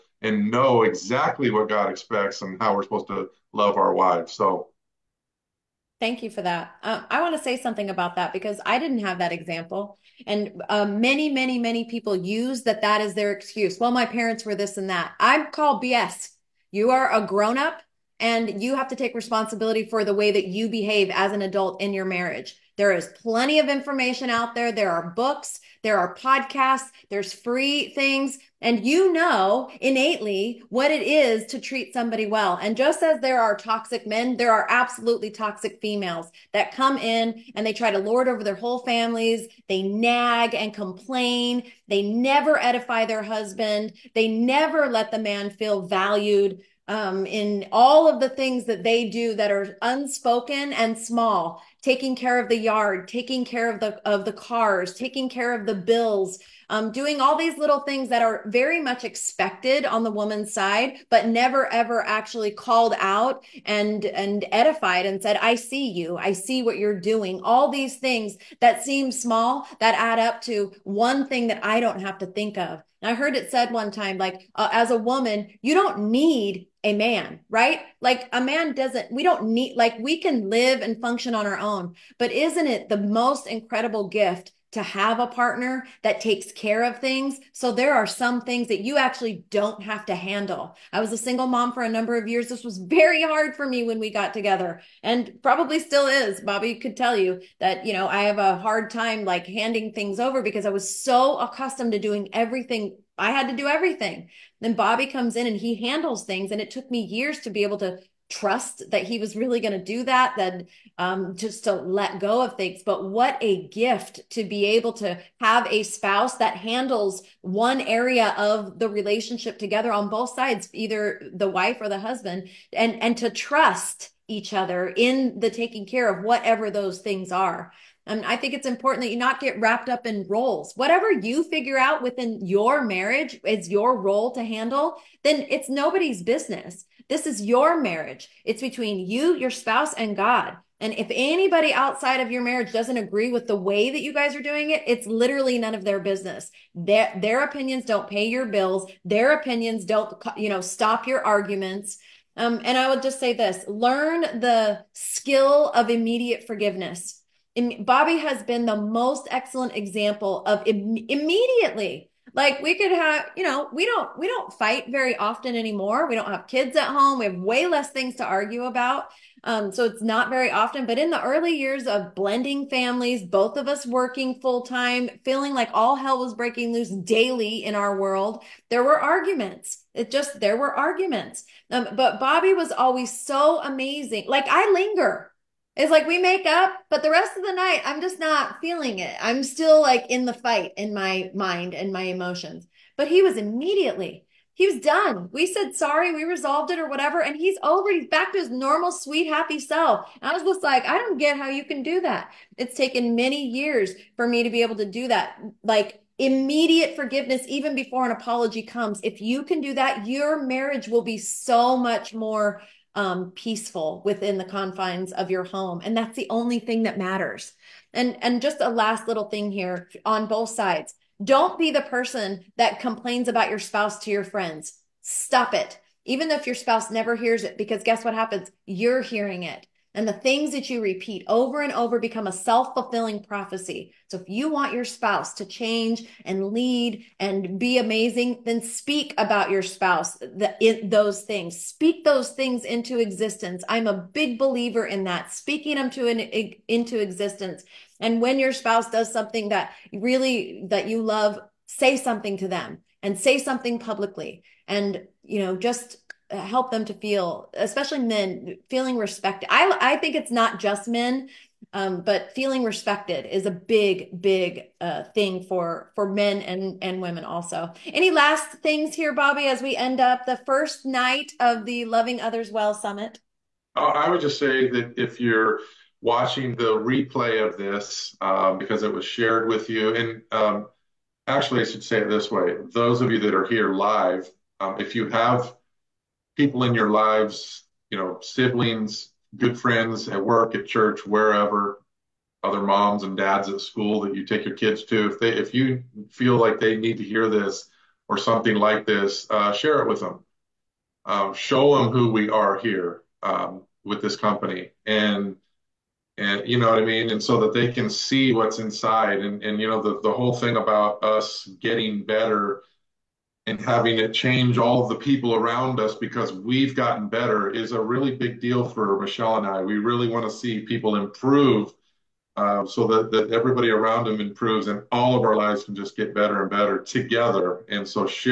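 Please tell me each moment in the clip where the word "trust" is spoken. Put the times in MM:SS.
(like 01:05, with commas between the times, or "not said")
01:48, 02:03.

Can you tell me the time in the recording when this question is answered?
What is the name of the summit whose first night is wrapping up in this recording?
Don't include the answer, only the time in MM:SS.
04:31.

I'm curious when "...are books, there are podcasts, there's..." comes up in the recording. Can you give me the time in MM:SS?
00:24.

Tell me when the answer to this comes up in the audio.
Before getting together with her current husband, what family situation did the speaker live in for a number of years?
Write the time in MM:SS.
01:31.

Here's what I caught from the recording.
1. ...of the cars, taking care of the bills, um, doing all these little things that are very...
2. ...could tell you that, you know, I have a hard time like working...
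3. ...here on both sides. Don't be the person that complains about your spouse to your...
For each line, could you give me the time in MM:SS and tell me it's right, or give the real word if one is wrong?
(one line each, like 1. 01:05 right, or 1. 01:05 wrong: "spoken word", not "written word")
1. 00:54 right
2. 01:36 wrong: "handing", not "working"
3. 03:39 right.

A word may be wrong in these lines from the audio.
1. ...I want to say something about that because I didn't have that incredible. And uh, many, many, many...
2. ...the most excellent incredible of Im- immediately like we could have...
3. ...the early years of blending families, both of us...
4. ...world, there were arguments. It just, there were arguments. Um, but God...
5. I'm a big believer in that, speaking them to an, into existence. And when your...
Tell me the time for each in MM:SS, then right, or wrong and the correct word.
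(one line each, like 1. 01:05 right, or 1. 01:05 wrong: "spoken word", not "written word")
1. 00:07 wrong: "example", not "incredible"
2. 02:38 wrong: "example", not "incredible"
3. 02:51 right
4. 02:57 wrong: "Bobby", not "God"
5. 04:03 right.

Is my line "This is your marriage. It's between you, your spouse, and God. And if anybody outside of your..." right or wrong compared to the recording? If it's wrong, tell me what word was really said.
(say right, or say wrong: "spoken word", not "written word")
right.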